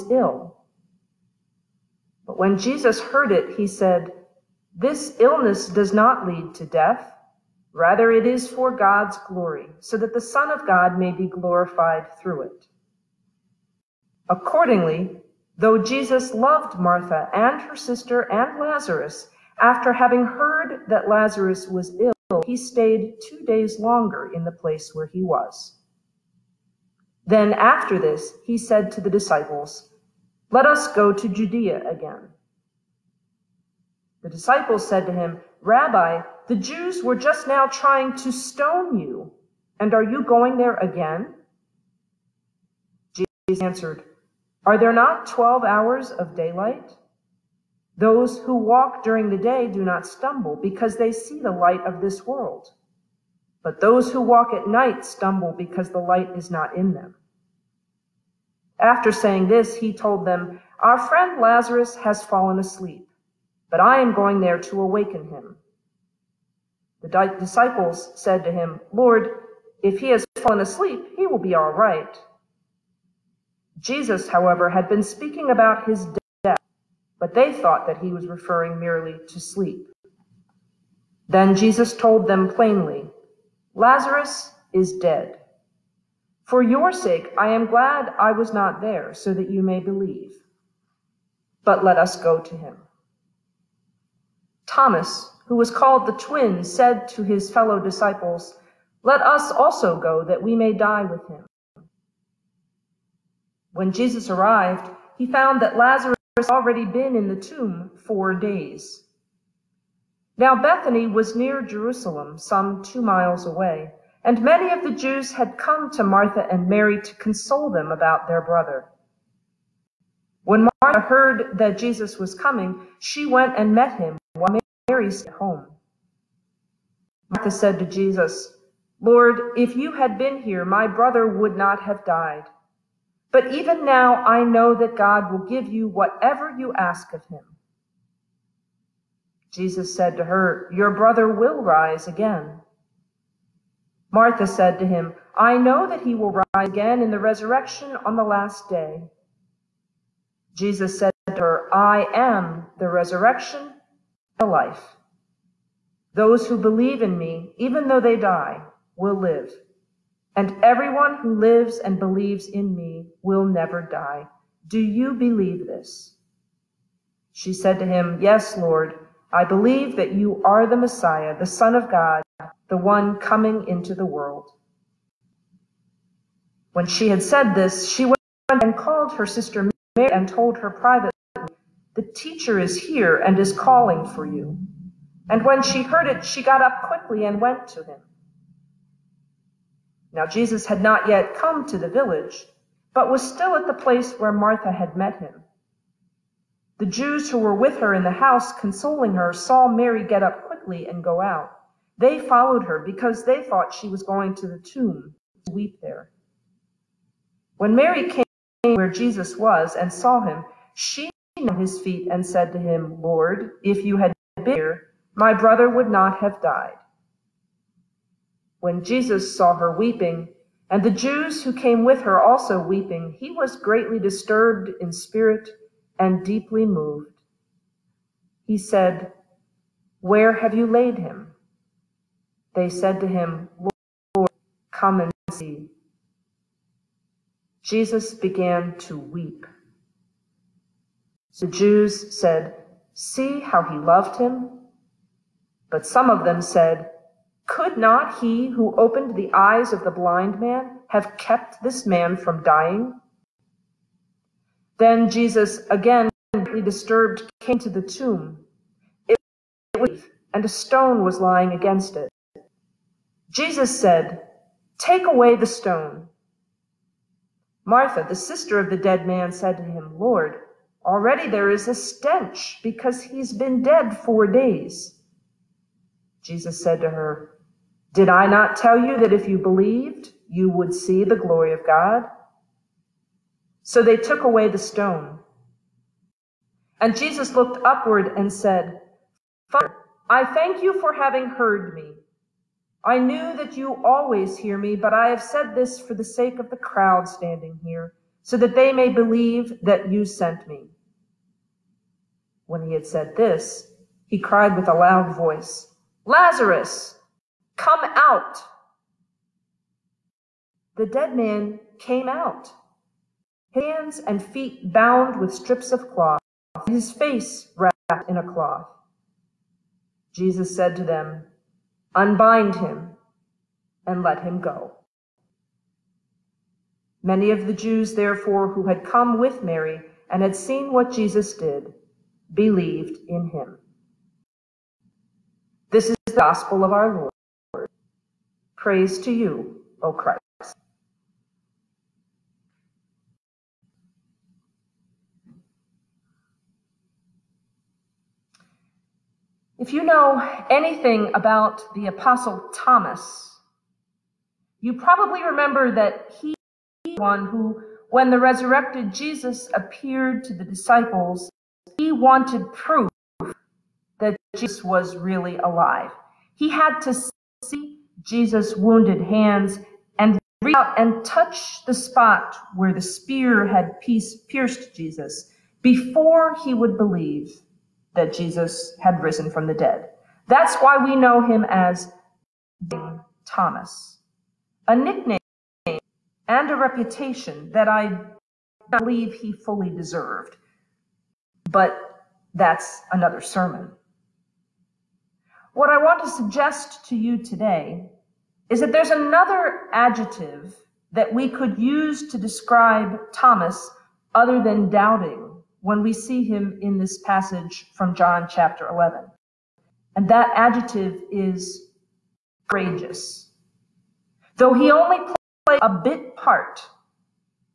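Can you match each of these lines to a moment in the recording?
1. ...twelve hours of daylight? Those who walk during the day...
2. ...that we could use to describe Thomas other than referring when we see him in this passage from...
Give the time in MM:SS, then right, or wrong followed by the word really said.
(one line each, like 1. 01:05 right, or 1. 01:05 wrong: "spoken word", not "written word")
1. 00:45 right
2. 06:40 wrong: "doubting", not "referring".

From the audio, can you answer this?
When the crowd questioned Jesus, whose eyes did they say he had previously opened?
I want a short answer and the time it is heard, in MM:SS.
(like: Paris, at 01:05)
the blind man, at 04:09.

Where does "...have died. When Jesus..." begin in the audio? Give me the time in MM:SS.
03:36.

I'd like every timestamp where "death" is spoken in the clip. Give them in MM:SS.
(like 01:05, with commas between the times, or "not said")
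00:06, 01:16.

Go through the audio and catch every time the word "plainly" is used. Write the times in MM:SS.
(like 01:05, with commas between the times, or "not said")
01:22.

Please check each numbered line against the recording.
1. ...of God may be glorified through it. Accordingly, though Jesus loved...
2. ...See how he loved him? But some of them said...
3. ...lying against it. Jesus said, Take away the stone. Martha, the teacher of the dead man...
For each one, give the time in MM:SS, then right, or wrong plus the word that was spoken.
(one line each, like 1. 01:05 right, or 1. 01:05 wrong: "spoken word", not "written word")
1. 00:10 right
2. 04:02 right
3. 04:21 wrong: "sister", not "teacher".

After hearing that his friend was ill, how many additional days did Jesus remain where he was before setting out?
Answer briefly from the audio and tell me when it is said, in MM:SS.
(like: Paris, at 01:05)
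2, at 00:23.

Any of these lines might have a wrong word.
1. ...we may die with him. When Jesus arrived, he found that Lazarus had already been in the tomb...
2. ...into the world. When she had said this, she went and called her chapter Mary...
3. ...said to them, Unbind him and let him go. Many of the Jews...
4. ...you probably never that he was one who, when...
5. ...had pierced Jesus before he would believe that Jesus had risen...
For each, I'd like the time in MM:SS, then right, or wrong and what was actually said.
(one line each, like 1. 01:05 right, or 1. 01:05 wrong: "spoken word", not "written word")
1. 01:40 right
2. 02:53 wrong: "sister", not "chapter"
3. 05:20 right
4. 05:54 wrong: "remember", not "never"
5. 06:13 right.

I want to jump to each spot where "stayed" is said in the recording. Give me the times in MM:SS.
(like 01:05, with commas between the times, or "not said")
00:22, 02:05.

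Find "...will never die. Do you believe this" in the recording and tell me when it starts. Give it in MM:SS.
02:43.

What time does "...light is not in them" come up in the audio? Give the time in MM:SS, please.
00:55.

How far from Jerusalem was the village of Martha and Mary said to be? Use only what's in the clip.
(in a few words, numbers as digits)
2 miles.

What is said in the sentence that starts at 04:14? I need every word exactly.
Then Jesus, again greatly disturbed, came to the tomb.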